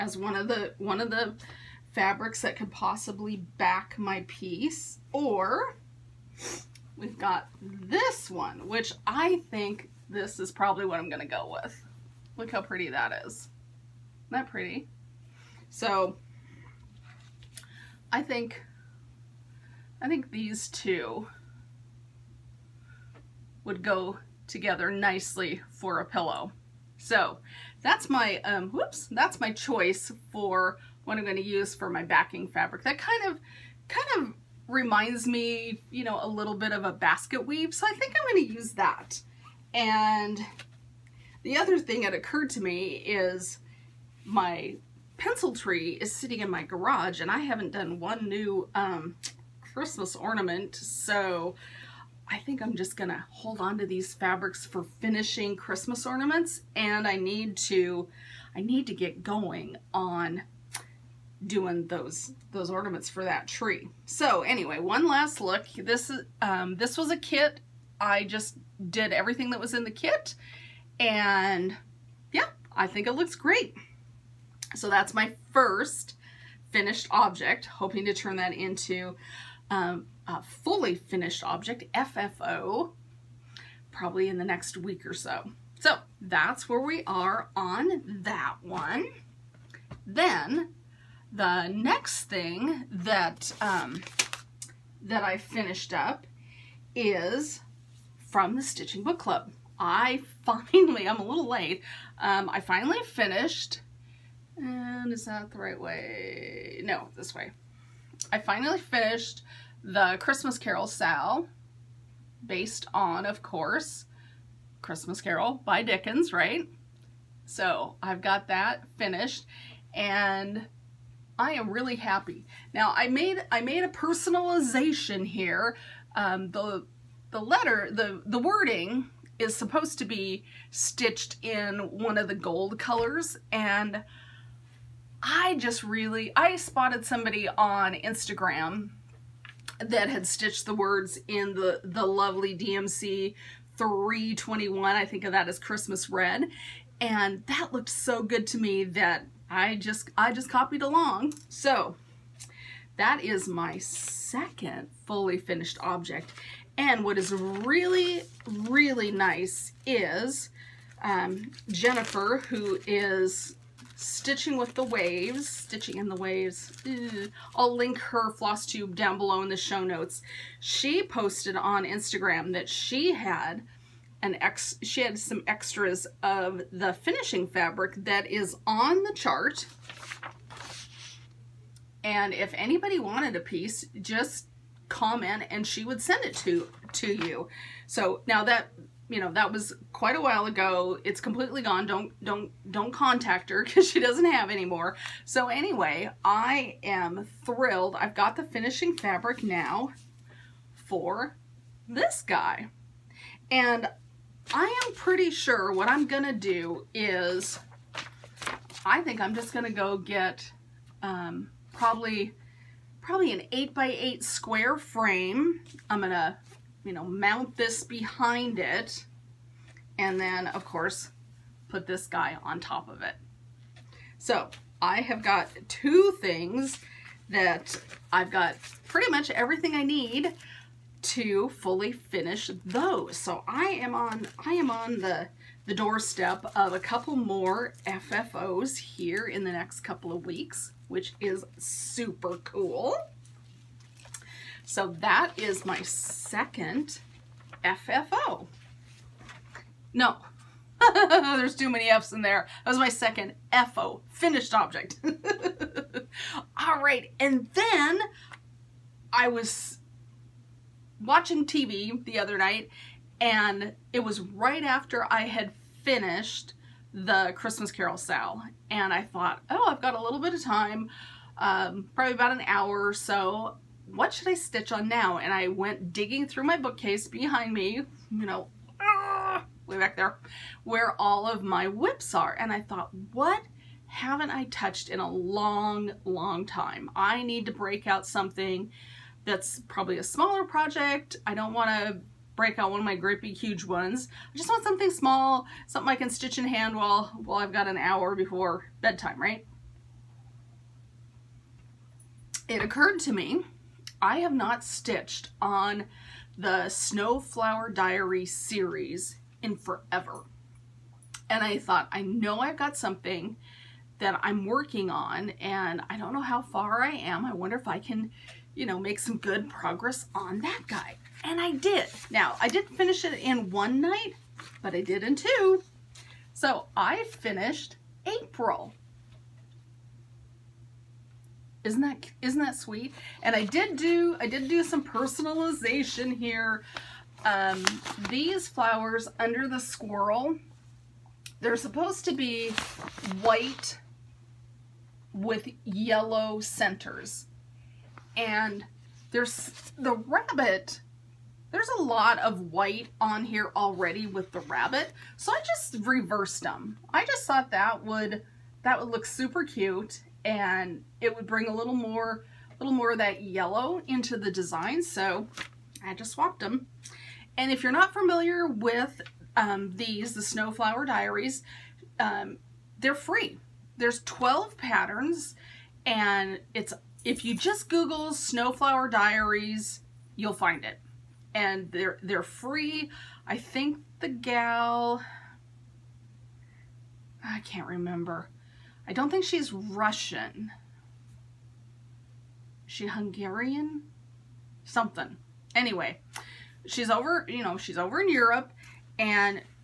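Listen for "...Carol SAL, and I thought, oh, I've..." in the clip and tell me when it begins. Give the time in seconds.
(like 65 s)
267 s.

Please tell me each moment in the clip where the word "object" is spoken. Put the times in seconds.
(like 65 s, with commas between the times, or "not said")
77 s, 81 s, 155 s, 254 s.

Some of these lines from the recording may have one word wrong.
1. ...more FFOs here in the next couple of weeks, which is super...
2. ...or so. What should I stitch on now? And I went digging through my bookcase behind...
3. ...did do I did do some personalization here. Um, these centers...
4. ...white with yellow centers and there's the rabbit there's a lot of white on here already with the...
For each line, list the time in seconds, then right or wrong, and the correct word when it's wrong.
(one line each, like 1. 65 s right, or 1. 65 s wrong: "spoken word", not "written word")
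1. 237 s right
2. 272 s right
3. 333 s wrong: "flowers", not "centers"
4. 343 s right.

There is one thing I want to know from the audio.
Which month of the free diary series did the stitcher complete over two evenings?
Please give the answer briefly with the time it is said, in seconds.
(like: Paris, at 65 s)
April, at 328 s.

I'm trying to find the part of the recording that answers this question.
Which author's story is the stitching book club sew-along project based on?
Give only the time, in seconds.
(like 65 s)
115 s.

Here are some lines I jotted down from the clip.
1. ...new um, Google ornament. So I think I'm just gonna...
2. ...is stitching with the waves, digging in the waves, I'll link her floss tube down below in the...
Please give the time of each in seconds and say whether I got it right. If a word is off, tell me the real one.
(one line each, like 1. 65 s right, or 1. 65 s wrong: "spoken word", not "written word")
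1. 48 s wrong: "Christmas", not "Google"
2. 162 s wrong: "stitching", not "digging".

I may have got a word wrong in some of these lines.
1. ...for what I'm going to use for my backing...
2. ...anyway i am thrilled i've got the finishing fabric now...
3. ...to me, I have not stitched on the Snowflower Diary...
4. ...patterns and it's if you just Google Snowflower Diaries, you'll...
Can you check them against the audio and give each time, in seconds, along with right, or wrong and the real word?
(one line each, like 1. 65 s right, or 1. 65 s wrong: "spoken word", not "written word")
1. 30 s right
2. 195 s right
3. 303 s right
4. 374 s right.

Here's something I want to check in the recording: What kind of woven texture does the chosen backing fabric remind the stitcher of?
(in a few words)
basket weave.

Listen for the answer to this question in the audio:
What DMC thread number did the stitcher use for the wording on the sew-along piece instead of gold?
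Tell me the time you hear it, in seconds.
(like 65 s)
143 s.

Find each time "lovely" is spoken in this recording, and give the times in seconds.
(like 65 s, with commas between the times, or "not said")
142 s.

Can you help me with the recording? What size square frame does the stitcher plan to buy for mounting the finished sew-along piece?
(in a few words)
8 by 8.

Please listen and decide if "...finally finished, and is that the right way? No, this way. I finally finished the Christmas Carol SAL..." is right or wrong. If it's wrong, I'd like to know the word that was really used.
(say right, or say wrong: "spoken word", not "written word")
right.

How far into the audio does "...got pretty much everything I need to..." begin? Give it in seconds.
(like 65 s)
228 s.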